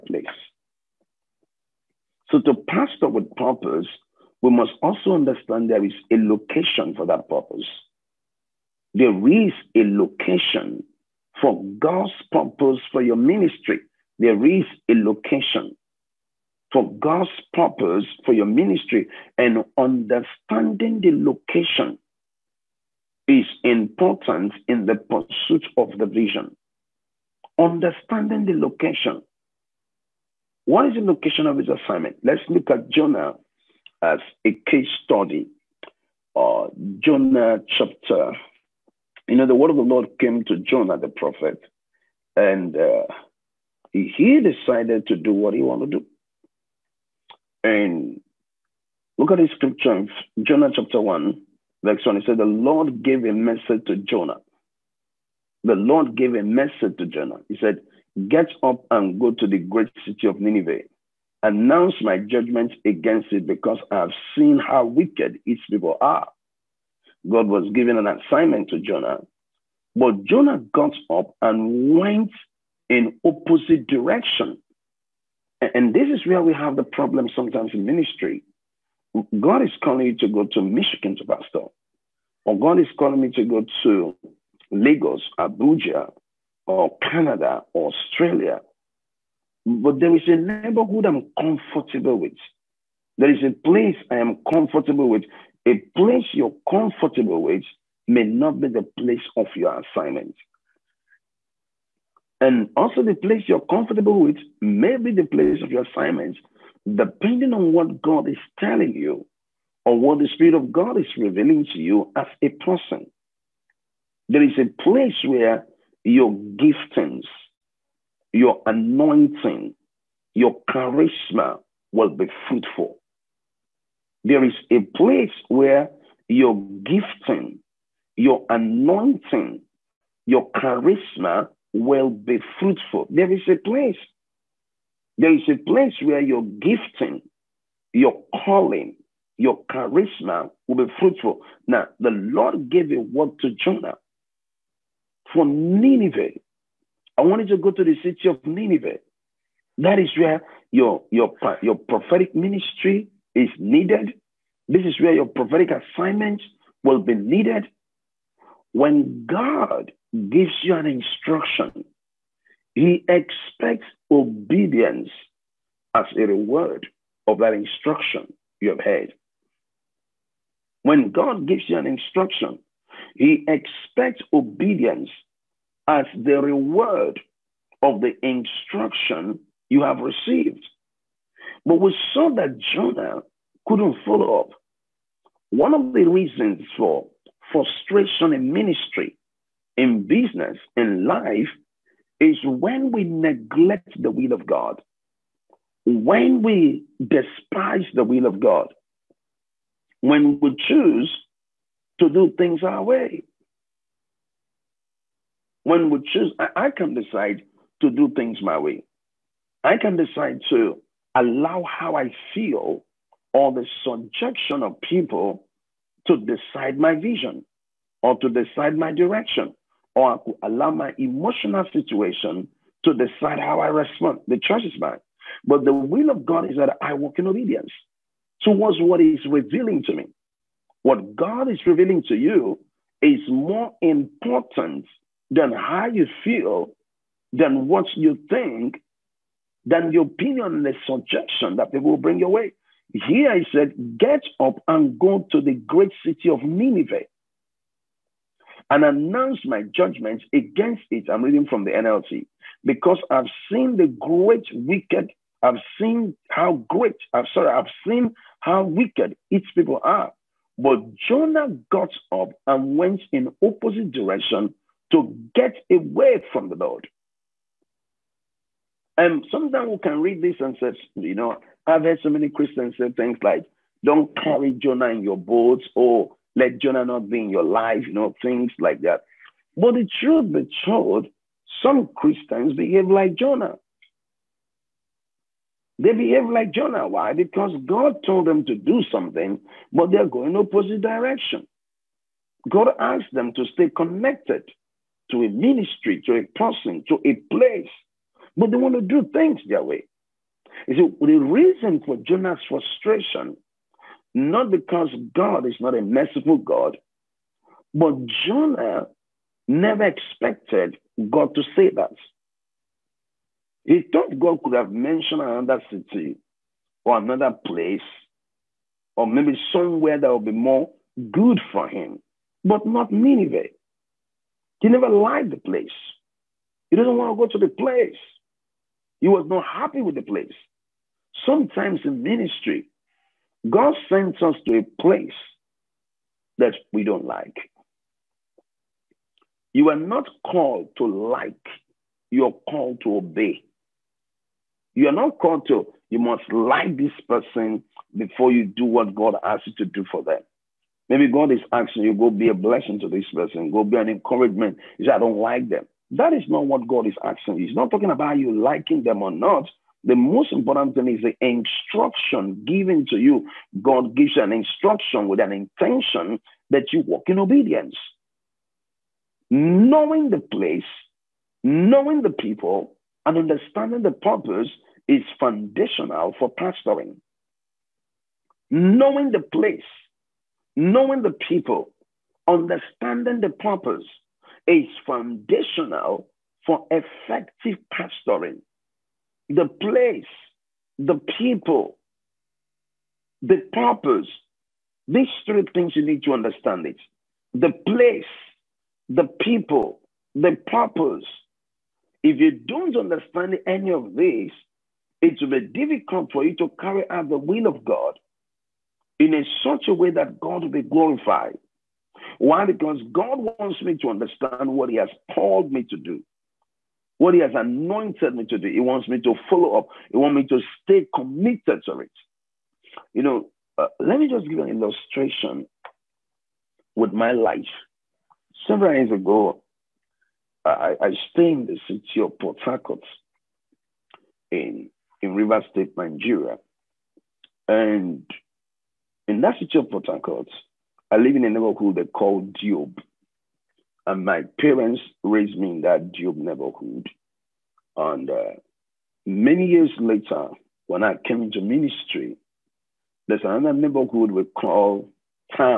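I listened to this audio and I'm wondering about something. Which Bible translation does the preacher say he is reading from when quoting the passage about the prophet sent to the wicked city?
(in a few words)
NLT.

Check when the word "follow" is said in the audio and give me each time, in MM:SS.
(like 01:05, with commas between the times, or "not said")
03:04, 06:59.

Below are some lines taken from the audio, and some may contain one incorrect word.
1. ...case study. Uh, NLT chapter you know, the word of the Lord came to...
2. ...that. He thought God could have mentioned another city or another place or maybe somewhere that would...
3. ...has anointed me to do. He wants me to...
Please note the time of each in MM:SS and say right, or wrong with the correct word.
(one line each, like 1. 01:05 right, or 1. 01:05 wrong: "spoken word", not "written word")
1. 00:34 wrong: "Jonah", not "NLT"
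2. 05:11 right
3. 06:57 right.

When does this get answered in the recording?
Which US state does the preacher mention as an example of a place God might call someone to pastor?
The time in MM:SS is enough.
01:20.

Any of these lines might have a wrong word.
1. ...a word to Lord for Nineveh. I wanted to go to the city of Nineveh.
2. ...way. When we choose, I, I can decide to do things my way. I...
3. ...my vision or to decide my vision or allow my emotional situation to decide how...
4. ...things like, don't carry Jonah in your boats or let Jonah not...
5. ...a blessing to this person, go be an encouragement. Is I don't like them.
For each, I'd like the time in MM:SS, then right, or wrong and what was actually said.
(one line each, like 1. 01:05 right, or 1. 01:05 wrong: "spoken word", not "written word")
1. 02:22 wrong: "Jonah", not "Lord"
2. 03:22 right
3. 03:36 wrong: "direction", not "vision"
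4. 04:32 right
5. 05:52 right.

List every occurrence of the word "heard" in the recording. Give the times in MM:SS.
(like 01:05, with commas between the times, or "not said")
02:48, 04:31.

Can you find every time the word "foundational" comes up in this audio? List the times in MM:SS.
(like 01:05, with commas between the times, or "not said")
06:15, 06:24.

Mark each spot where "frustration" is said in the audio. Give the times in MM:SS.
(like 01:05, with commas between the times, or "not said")
03:07, 05:02.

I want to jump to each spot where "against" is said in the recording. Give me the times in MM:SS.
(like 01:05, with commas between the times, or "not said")
01:02, 04:10.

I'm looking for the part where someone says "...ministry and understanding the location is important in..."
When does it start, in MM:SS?
00:18.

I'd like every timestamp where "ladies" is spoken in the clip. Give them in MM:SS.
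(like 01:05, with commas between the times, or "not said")
not said.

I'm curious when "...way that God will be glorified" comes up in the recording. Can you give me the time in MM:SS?
06:49.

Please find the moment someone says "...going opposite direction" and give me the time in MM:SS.
04:50.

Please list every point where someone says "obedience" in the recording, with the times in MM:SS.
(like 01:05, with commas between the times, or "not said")
02:44, 02:54, 03:47, 06:07.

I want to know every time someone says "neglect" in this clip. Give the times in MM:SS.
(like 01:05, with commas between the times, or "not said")
03:13.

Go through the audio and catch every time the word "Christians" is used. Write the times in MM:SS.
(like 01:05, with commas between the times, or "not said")
04:32, 04:41.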